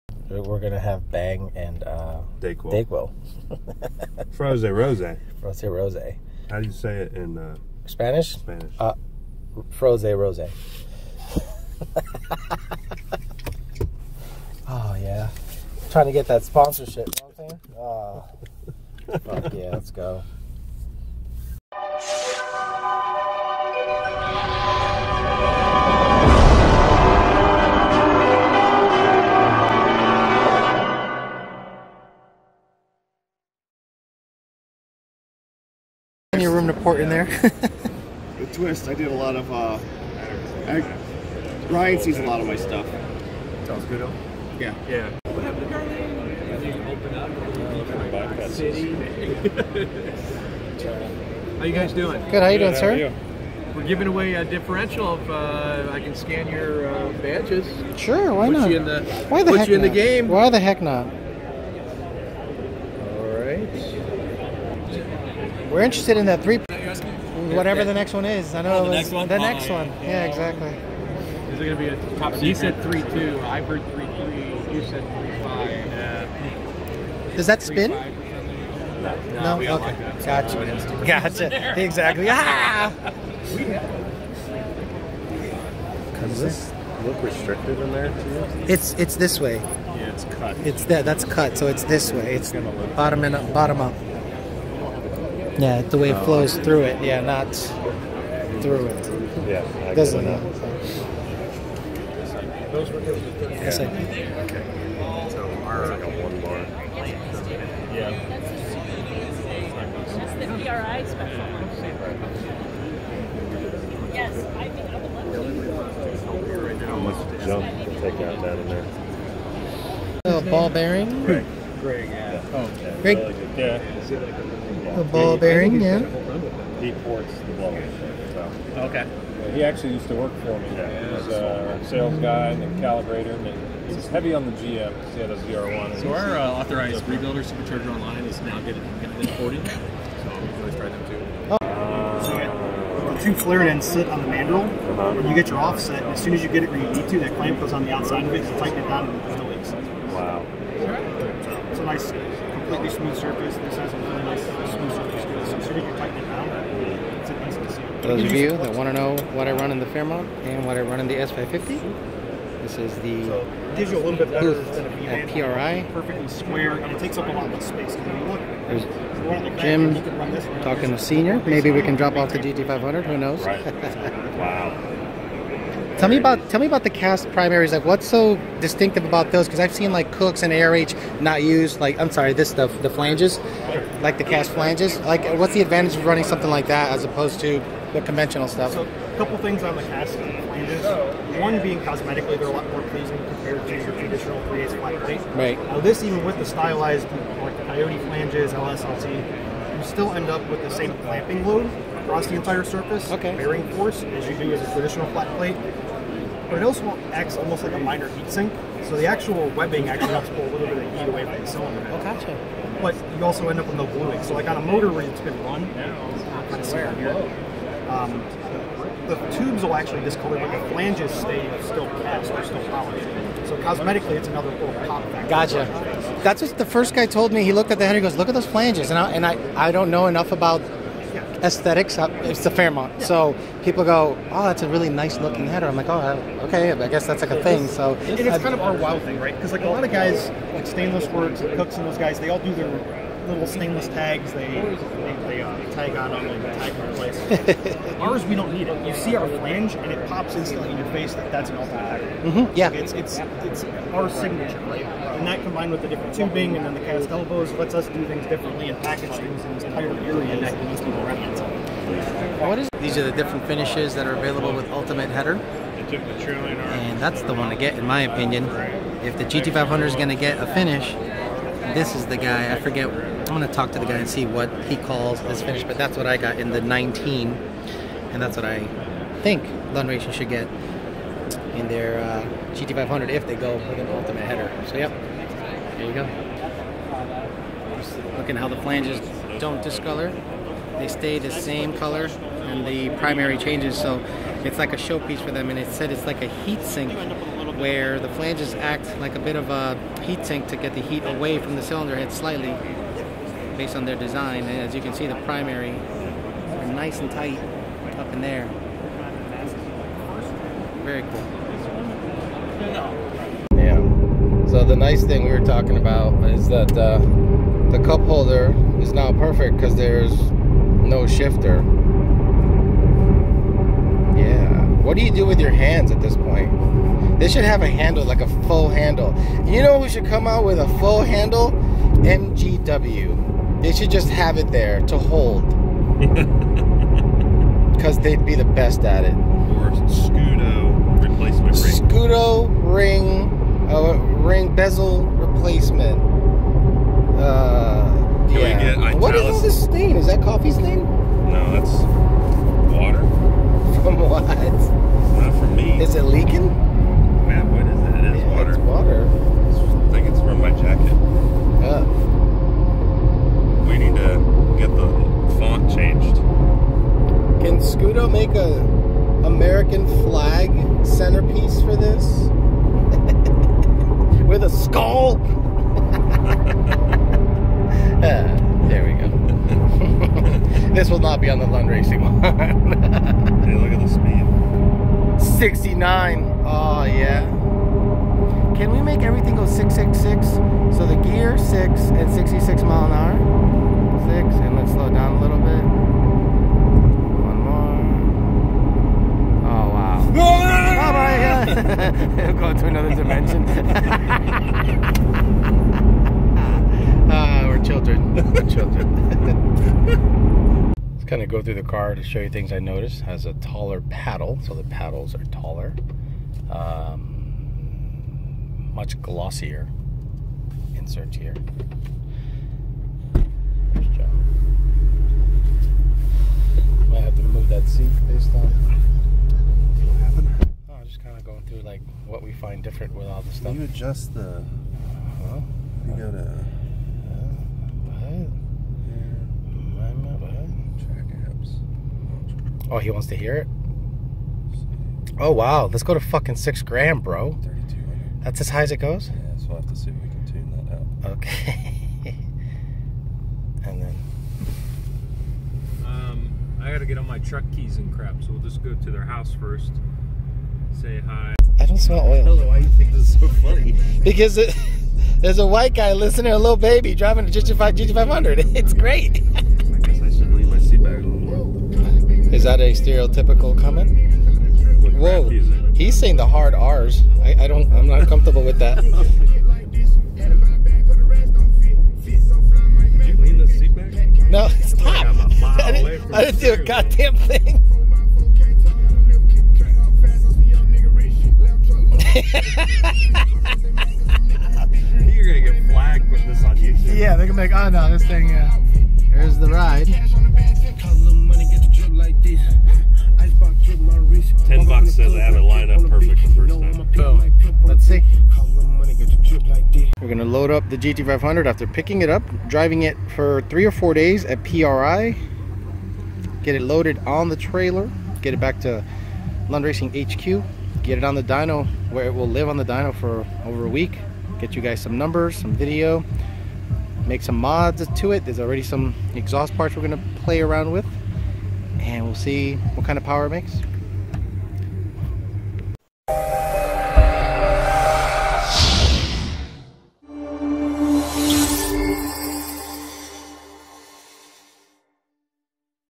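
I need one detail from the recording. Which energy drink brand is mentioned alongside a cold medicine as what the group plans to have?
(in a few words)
Bang.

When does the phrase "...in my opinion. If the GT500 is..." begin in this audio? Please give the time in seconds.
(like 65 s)
267 s.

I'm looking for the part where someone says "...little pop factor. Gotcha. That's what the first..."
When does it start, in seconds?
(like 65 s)
224 s.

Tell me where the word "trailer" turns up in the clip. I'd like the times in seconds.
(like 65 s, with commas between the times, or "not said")
517 s.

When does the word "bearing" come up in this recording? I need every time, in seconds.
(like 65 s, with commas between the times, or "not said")
120 s, 125 s, 203 s.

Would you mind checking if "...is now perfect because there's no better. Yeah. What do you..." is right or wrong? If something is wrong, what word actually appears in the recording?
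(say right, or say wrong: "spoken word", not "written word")
wrong: "shifter", not "better".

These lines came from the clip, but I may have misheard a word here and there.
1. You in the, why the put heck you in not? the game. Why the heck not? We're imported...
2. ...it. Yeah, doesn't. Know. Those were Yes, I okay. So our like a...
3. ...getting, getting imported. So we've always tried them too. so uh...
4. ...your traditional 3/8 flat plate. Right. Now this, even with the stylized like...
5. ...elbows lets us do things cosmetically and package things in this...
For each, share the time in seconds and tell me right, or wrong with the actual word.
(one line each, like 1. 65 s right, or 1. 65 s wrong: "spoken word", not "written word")
1. 58 s wrong: "interested", not "imported"
2. 98 s right
3. 138 s right
4. 193 s right
5. 257 s wrong: "differently", not "cosmetically".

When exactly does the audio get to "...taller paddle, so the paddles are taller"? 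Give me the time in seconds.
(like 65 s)
413 s.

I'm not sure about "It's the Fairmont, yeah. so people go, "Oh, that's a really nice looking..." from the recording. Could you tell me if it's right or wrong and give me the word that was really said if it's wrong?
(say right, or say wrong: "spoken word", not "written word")
right.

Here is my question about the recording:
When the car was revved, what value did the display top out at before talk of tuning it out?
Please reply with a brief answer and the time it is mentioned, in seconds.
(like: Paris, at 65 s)
32, at 447 s.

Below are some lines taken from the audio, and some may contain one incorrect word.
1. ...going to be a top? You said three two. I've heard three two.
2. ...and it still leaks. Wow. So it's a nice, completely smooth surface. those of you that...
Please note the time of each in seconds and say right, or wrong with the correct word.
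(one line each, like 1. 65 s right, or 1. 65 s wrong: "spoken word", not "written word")
1. 71 s wrong: "three", not "two"
2. 149 s right.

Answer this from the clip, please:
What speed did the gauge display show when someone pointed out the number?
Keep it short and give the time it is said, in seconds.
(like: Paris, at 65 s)
69, at 385 s.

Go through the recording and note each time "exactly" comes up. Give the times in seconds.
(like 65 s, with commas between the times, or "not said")
70 s, 81 s.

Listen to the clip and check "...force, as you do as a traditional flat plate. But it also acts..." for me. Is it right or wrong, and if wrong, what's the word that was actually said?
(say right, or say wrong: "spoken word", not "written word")
right.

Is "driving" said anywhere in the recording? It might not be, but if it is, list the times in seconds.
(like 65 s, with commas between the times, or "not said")
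466 s, 512 s.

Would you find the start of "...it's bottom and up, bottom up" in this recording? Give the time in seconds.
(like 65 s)
92 s.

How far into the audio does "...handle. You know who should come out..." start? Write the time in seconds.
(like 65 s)
328 s.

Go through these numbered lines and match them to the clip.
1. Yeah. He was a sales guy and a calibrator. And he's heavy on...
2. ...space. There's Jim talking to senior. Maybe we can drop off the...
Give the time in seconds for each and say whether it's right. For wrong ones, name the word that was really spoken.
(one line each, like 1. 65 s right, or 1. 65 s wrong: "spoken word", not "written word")
1. 130 s right
2. 167 s right.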